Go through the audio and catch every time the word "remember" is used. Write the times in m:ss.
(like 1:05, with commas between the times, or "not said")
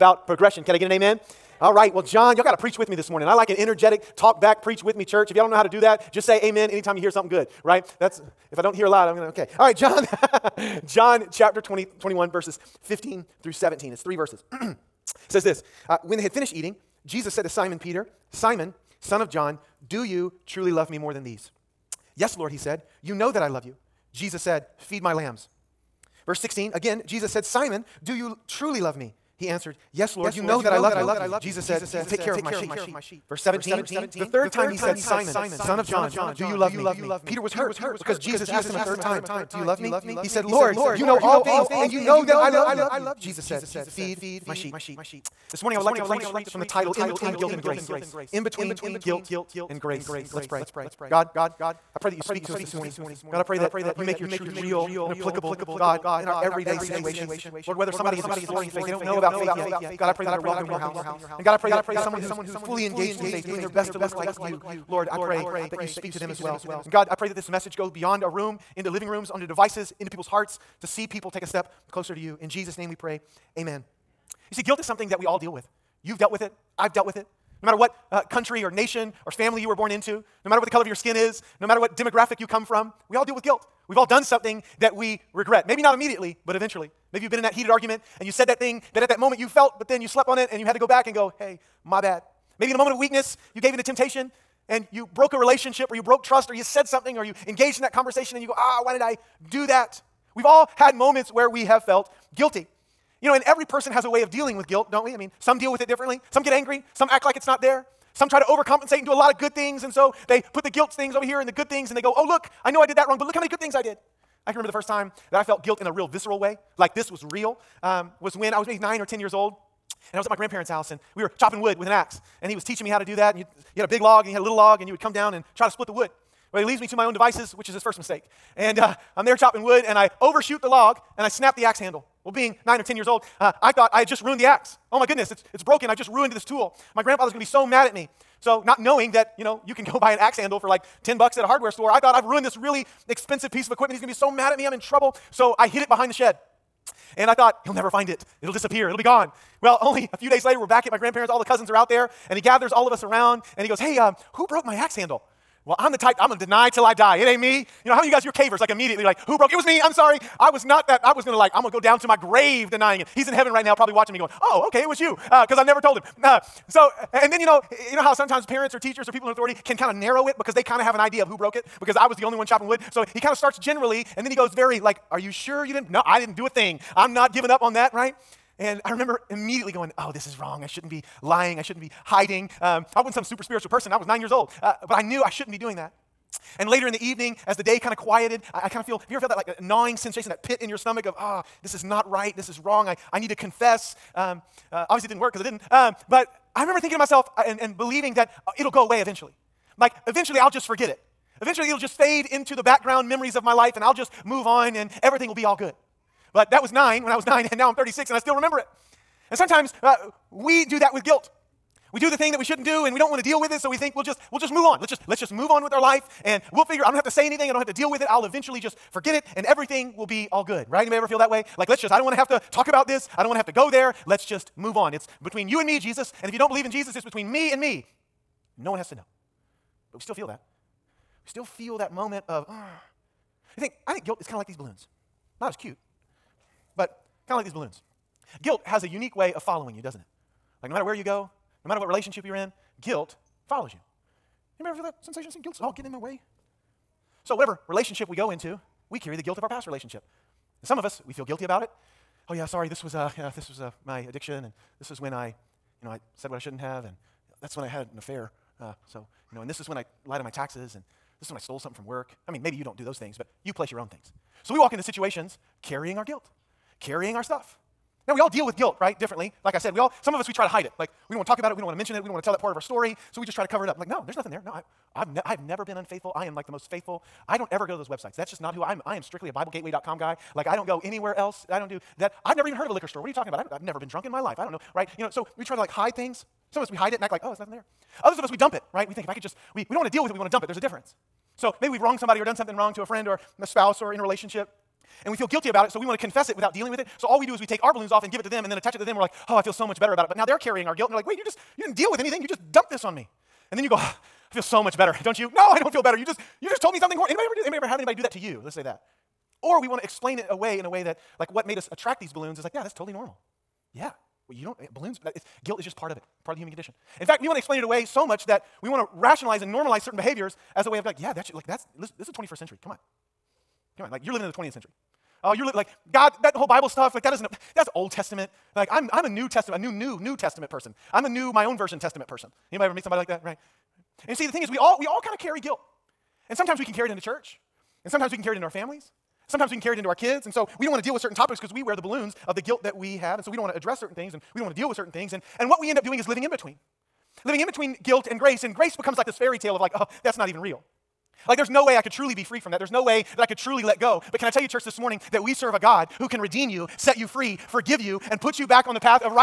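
1:54, 2:58, 3:16, 3:28.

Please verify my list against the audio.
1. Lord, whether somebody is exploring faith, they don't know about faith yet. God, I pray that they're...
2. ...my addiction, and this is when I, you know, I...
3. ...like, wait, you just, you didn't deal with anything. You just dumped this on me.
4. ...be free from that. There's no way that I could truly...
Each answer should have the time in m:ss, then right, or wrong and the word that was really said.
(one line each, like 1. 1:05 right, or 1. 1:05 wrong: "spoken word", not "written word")
1. 0:57 right
2. 4:13 right
3. 5:00 right
4. 5:52 right.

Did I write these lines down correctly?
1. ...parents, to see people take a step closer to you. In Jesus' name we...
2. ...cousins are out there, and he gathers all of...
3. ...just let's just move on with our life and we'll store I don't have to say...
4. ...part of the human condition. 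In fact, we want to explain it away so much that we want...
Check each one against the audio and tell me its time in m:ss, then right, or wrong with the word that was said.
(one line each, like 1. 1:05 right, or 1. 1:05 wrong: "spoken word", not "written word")
1. 1:10 wrong: "hearts", not "parents"
2. 2:31 right
3. 3:34 wrong: "figure", not "store"
4. 5:16 right.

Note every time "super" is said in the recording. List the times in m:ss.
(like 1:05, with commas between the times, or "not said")
3:03.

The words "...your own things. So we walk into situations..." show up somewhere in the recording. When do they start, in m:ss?
4:23.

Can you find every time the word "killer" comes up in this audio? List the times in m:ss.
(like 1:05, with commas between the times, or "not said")
not said.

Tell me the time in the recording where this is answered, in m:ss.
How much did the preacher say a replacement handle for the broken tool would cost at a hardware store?
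2:21.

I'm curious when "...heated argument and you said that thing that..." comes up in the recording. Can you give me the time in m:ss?
1:27.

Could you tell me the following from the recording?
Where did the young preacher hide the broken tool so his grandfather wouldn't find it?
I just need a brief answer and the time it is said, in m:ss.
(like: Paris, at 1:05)
Behind the shed, at 2:25.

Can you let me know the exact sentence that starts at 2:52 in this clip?
So he kind of starts generally and then he goes very like are you sure you didn't?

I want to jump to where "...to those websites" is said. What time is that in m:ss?
4:37.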